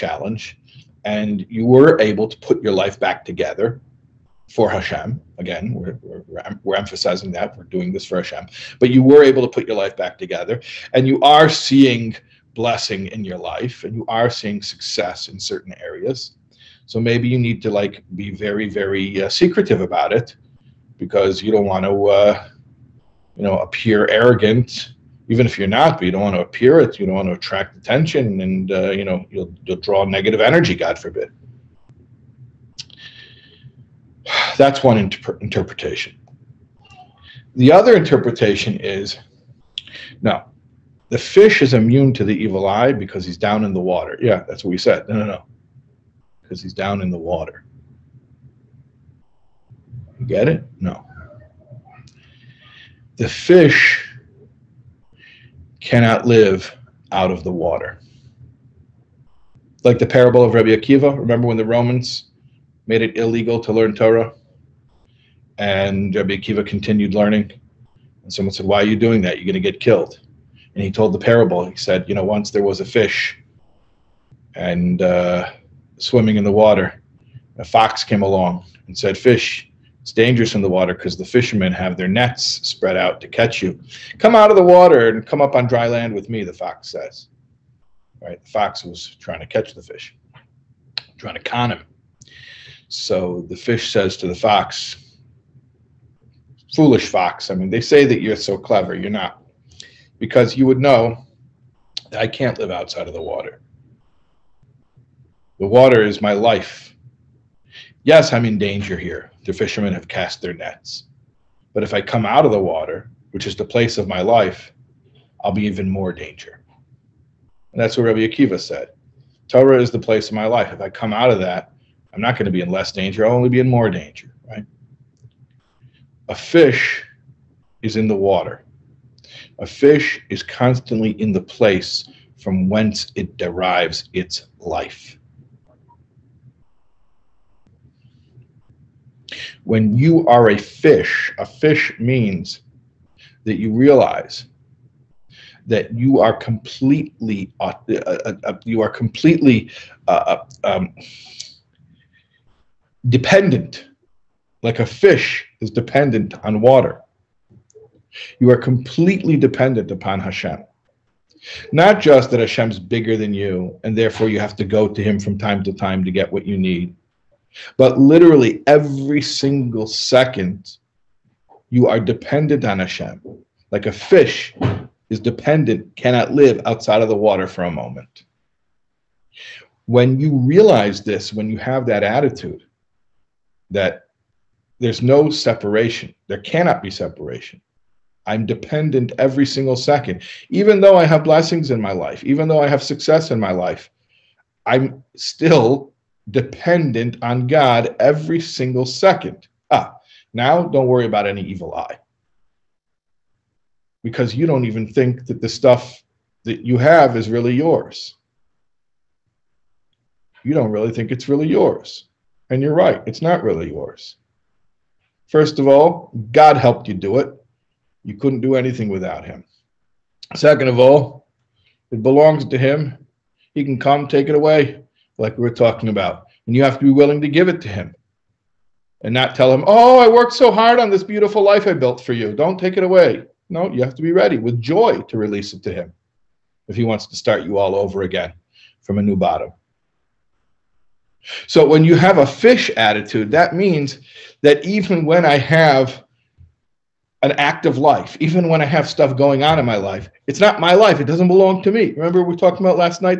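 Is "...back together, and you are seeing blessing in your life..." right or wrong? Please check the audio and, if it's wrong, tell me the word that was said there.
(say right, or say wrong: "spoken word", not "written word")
right.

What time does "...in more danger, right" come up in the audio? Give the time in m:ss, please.
2:03.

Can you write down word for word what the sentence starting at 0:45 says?
No, no, no, because he's down in the water.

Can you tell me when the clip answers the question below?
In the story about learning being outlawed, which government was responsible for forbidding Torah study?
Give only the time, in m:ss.
1:01.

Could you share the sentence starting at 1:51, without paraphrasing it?
But if I come out of the water, which is the place of my life, I'll be even more danger.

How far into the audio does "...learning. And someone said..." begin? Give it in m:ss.
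1:07.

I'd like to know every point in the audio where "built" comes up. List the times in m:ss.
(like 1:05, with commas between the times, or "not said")
3:51.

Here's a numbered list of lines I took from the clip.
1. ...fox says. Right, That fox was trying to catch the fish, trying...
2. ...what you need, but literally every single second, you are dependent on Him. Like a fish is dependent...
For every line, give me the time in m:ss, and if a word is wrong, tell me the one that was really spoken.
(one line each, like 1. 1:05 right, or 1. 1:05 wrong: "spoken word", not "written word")
1. 1:26 wrong: "The", not "That"
2. 2:46 wrong: "Hashem", not "Him".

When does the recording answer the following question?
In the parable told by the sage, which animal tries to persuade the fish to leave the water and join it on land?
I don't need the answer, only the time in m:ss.
1:17.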